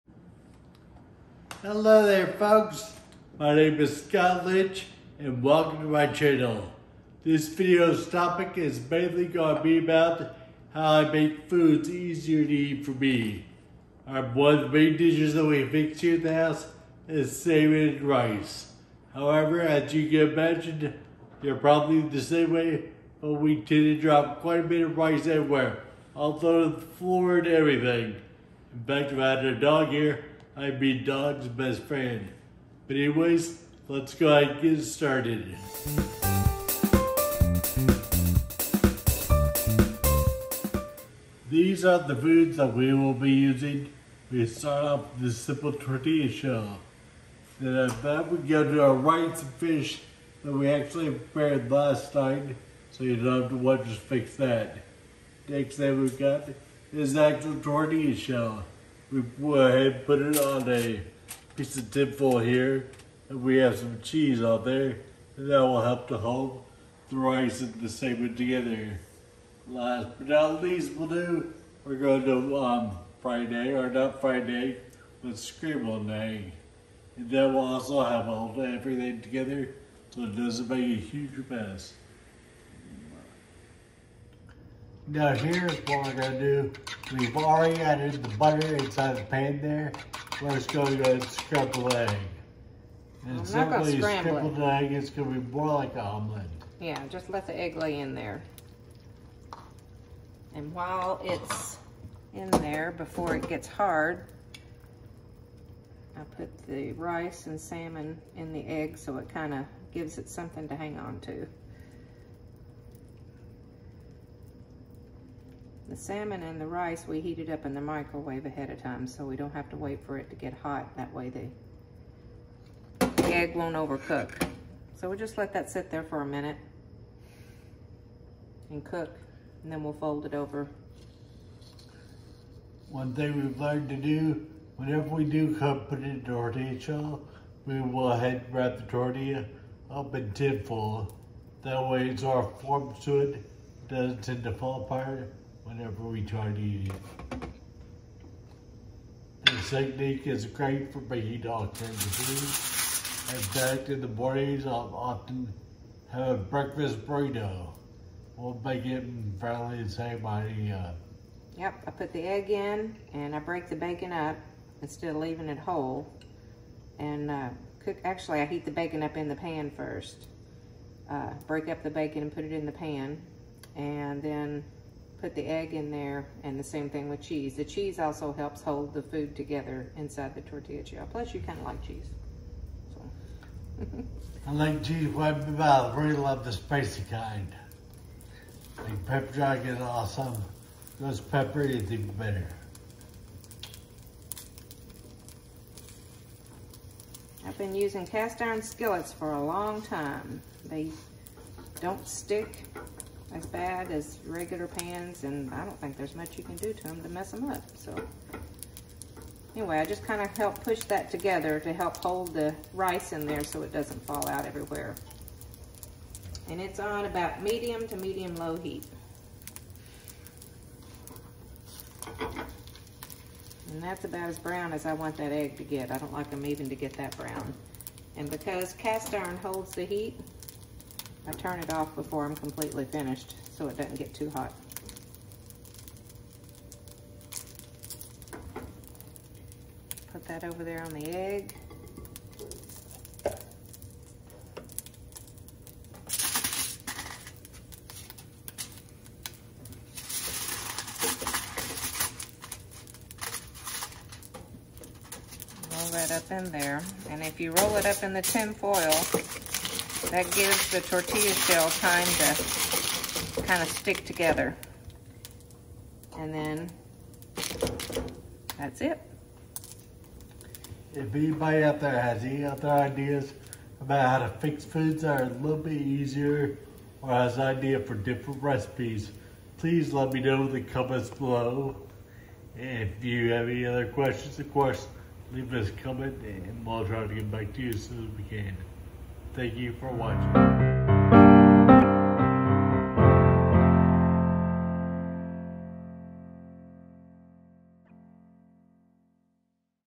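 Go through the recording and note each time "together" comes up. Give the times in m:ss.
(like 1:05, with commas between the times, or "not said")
1:08, 1:19, 2:59, 3:31, 4:24.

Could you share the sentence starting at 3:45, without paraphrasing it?
I don't like them even to get that brown.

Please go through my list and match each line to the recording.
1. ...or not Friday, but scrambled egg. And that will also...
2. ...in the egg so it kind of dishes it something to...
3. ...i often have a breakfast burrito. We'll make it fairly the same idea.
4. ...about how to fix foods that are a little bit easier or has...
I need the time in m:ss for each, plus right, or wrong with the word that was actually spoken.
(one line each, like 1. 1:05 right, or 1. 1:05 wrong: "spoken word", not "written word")
1. 1:13 right
2. 1:48 wrong: "gives", not "dishes"
3. 2:34 right
4. 4:33 right.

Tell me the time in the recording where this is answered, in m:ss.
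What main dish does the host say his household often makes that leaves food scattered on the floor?
0:17.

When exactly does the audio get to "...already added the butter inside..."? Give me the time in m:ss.
1:27.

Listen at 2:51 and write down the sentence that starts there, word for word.
Uh, break up the bacon and put it in the pan.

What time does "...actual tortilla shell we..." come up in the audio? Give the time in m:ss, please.
0:57.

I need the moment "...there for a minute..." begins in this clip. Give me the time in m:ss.
2:05.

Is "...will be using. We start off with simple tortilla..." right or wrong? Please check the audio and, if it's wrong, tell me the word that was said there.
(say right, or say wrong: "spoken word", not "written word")
right.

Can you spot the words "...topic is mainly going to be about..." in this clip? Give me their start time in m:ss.
0:08.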